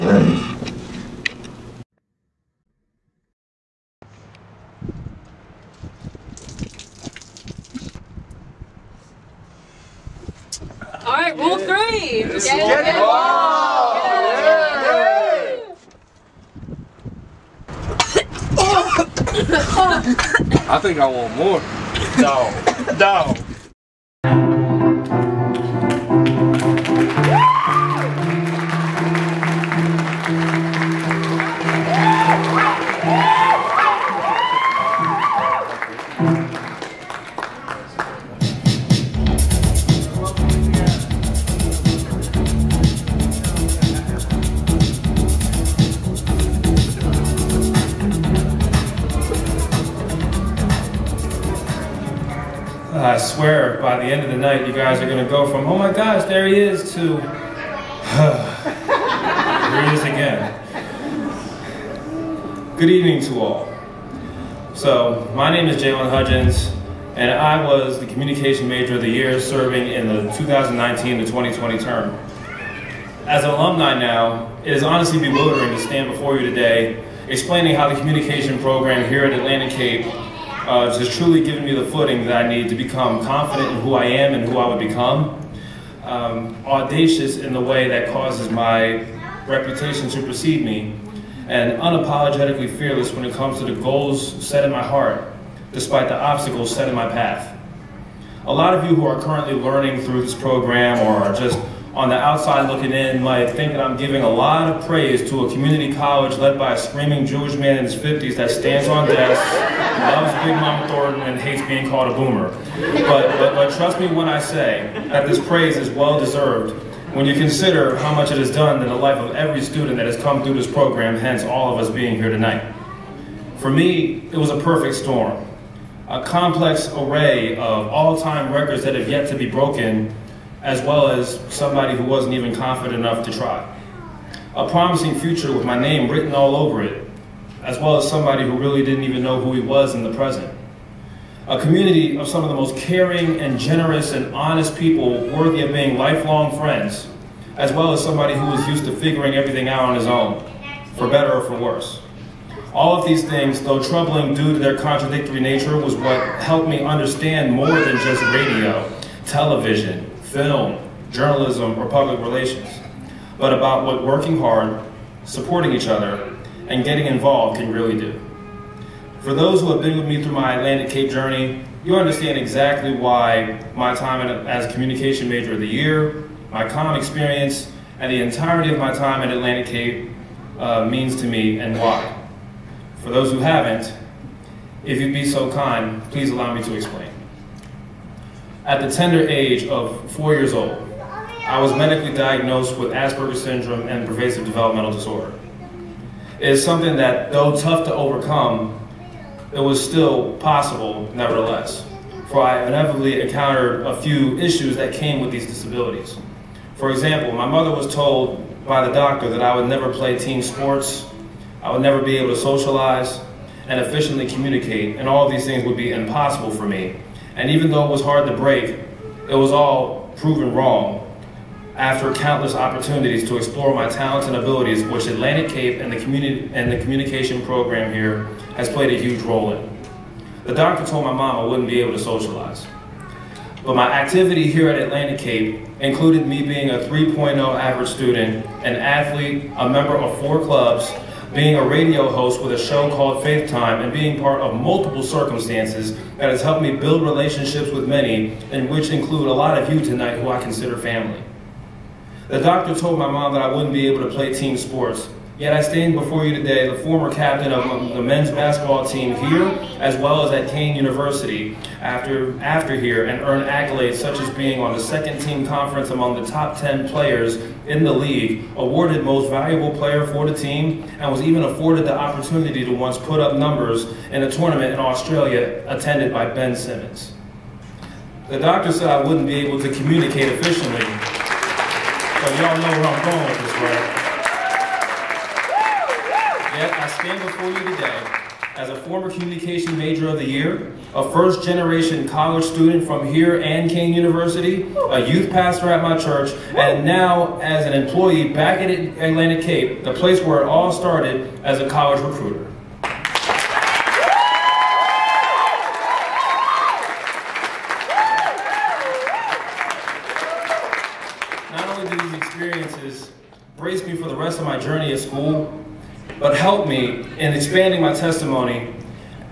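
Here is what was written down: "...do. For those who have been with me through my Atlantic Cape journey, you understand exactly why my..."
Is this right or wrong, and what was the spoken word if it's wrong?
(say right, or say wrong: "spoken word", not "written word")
right.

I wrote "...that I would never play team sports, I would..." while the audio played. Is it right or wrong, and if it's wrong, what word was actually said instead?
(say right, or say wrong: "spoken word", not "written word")
right.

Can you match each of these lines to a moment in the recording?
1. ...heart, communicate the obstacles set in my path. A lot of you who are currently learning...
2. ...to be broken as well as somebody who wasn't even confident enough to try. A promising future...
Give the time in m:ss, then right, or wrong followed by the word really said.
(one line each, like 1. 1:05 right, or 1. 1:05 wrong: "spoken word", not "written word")
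1. 1:34 wrong: "despite", not "communicate"
2. 2:09 right.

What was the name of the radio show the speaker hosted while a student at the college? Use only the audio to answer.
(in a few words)
Faith Time.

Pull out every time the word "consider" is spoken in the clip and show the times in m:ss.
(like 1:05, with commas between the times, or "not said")
1:57, 4:10.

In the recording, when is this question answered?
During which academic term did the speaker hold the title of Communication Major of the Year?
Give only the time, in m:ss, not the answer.
1:10.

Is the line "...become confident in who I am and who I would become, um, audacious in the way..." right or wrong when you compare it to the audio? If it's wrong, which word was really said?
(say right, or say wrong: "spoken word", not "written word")
right.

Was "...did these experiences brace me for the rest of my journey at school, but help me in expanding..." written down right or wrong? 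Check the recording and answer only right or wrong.
right.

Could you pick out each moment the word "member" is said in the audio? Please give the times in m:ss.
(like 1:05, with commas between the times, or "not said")
3:59.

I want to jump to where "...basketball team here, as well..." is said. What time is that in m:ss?
4:18.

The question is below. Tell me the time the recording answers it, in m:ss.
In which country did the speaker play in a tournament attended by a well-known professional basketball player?
4:34.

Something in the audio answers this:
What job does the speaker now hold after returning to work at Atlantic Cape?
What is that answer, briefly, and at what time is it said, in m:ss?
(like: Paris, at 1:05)
College recruiter, at 5:01.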